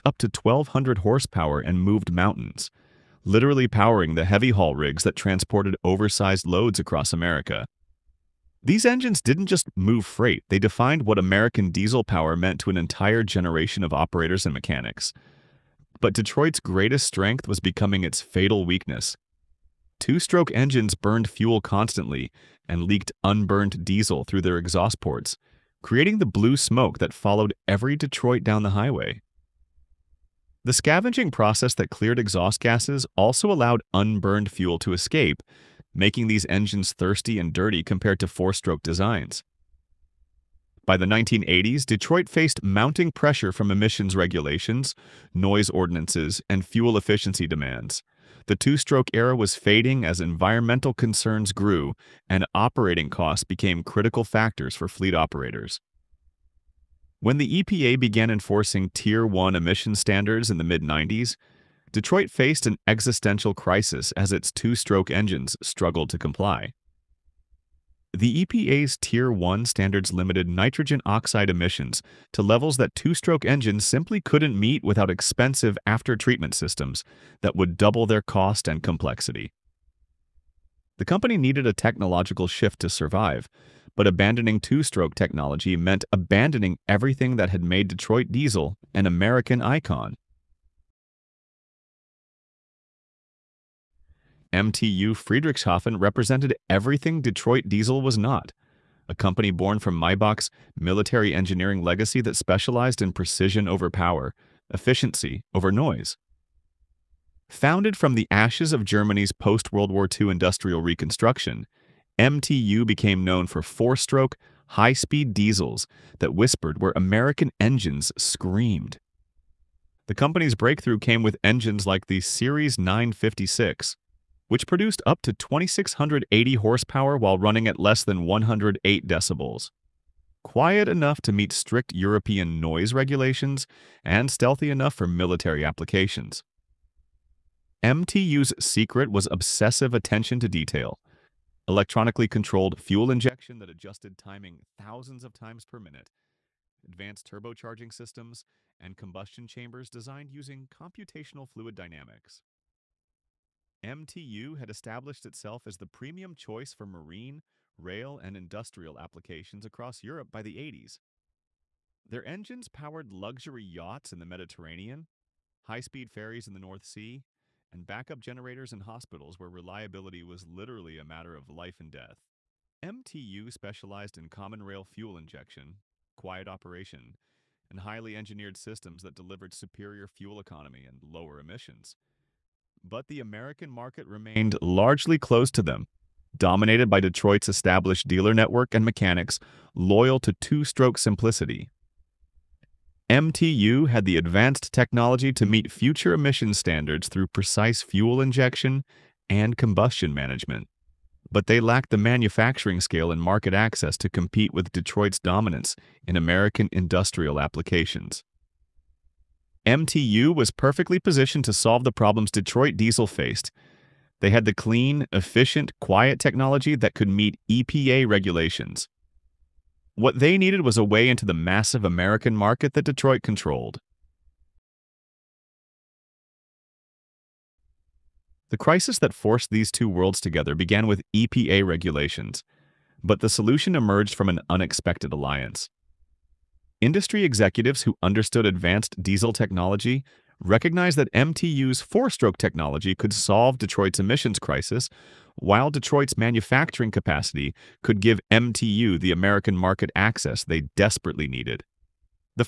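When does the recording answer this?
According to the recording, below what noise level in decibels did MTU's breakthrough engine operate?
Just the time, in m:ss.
2:08.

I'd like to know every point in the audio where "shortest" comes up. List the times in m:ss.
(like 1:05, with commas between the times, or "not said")
not said.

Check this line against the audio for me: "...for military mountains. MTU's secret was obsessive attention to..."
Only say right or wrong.
wrong.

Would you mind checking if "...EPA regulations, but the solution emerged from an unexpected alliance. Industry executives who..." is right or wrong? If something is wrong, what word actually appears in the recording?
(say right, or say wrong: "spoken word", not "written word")
right.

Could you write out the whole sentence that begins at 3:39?
What they needed was a way into the massive American market that Detroit controlled.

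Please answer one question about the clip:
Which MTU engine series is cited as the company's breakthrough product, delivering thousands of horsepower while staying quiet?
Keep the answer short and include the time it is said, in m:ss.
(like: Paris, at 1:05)
Series 956, at 2:02.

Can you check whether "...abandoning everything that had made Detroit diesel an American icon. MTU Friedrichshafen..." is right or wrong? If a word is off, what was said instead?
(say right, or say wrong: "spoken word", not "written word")
right.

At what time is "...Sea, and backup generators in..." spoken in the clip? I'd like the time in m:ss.
2:46.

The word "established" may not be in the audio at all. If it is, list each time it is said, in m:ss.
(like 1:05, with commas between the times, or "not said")
2:34, 3:07.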